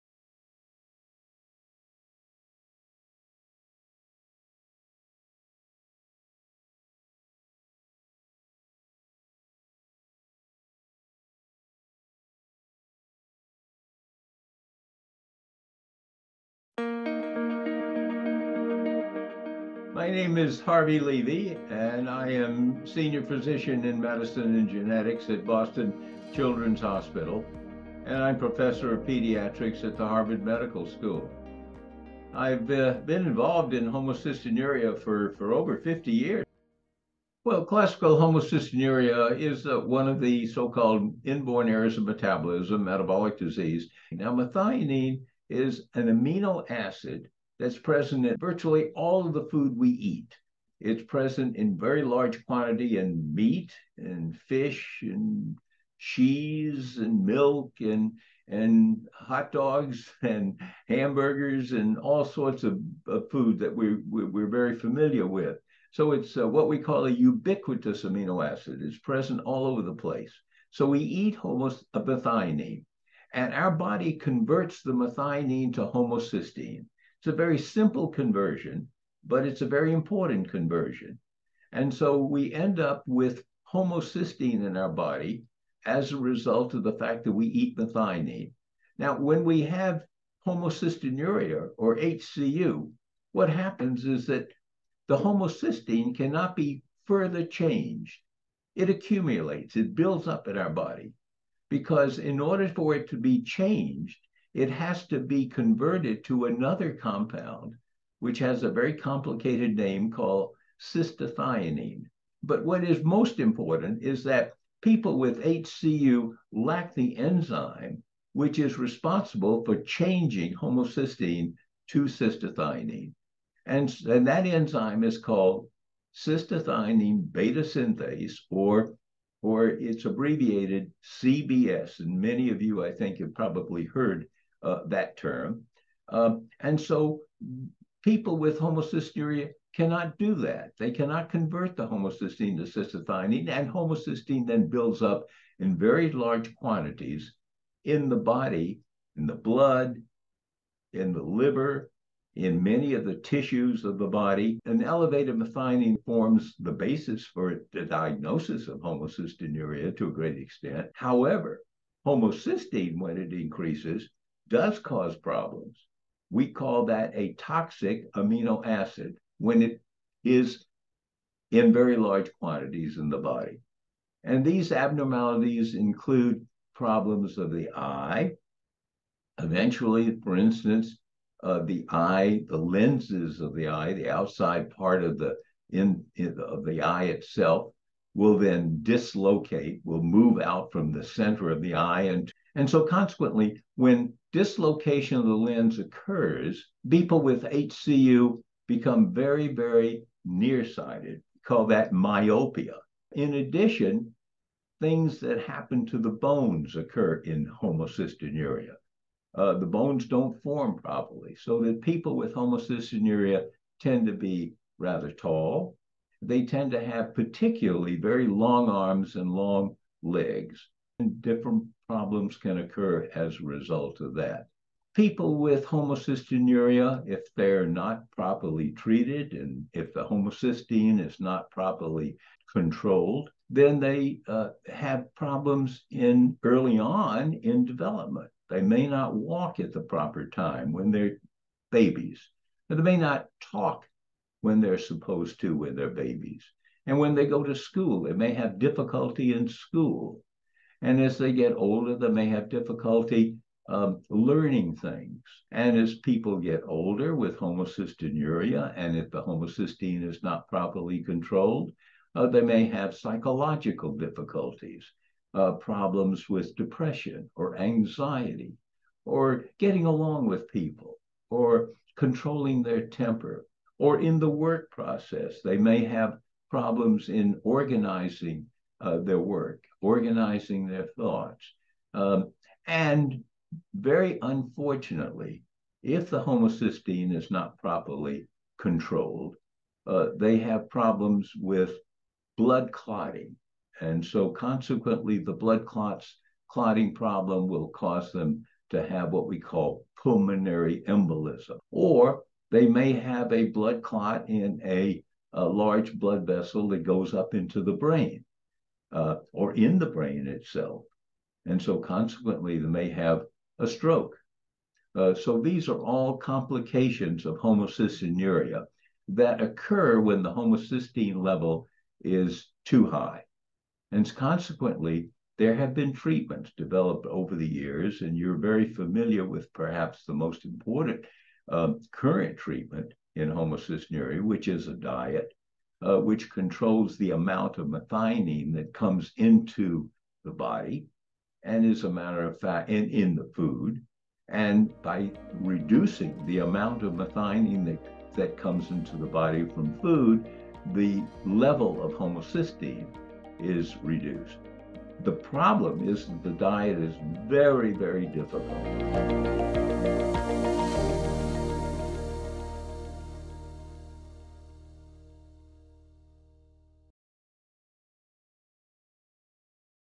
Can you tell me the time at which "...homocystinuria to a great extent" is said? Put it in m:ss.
2:38.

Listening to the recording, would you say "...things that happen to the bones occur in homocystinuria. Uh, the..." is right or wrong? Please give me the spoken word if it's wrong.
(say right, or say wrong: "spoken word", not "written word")
right.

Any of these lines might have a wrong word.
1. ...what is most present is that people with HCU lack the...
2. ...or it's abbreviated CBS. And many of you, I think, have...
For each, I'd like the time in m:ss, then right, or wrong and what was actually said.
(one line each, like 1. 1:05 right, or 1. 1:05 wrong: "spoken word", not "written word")
1. 1:52 wrong: "important", not "present"
2. 2:09 right.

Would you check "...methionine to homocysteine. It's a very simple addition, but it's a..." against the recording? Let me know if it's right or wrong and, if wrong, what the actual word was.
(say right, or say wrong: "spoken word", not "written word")
wrong: "conversion", not "addition".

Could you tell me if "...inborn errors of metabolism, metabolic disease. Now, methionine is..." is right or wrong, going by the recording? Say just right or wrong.
right.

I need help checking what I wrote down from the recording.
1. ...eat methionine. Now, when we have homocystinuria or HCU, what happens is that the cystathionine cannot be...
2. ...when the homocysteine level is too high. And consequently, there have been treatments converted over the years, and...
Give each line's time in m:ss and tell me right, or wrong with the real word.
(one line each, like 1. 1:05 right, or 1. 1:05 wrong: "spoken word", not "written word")
1. 1:27 wrong: "homocysteine", not "cystathionine"
2. 5:19 wrong: "developed", not "converted".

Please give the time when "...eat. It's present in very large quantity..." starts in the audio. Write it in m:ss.
0:49.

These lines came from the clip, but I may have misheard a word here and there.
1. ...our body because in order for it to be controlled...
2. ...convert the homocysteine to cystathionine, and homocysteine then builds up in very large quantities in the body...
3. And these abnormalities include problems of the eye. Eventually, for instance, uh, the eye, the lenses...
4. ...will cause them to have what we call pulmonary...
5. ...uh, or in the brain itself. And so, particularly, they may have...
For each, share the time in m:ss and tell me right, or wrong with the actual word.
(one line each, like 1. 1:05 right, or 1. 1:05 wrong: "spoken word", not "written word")
1. 1:40 wrong: "changed", not "controlled"
2. 2:21 right
3. 2:54 right
4. 4:57 right
5. 5:08 wrong: "consequently", not "particularly".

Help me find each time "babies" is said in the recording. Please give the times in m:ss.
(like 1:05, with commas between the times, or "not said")
4:01, 4:05.